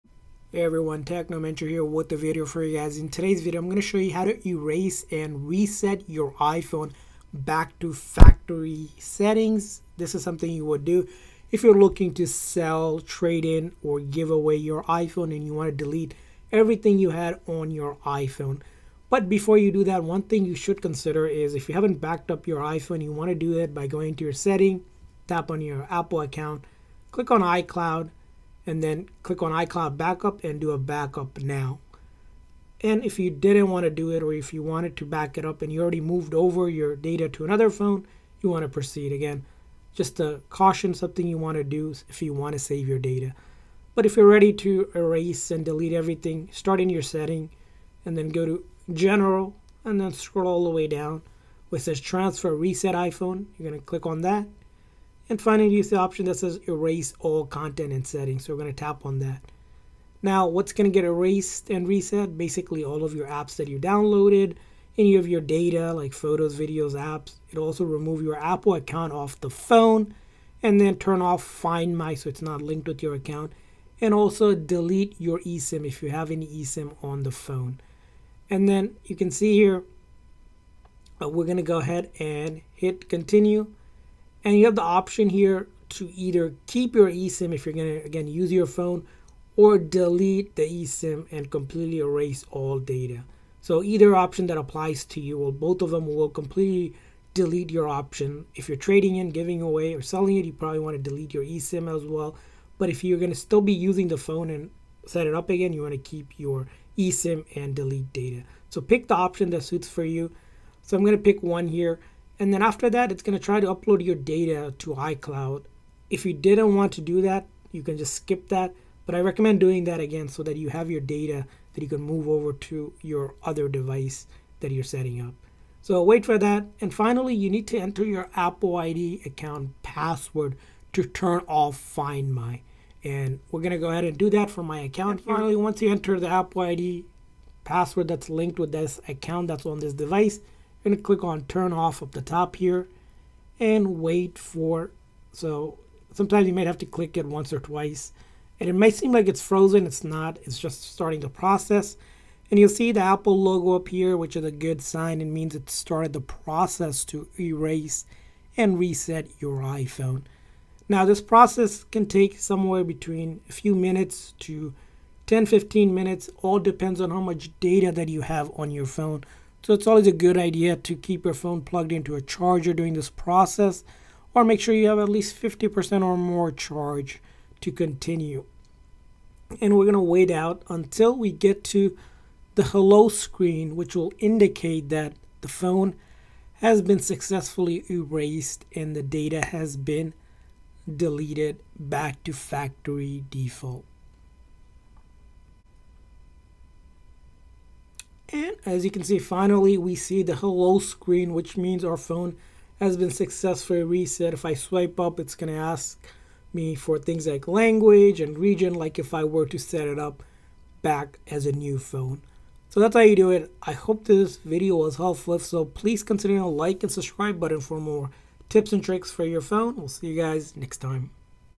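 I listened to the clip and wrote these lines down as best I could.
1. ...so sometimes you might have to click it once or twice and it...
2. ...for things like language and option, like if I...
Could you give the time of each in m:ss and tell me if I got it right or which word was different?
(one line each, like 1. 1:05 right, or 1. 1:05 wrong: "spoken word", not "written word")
1. 2:25 right
2. 3:26 wrong: "region", not "option".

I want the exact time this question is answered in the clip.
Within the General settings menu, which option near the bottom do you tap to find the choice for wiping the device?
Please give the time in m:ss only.
0:51.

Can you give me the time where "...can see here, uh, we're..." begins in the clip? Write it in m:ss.
1:19.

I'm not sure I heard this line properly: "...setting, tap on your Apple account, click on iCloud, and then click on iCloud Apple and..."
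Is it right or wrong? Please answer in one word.
wrong.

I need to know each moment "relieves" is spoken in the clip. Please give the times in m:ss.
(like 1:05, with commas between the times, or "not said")
not said.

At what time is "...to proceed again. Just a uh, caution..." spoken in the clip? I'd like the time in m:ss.
0:38.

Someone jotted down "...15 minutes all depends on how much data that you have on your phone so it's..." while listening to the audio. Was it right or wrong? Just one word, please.
right.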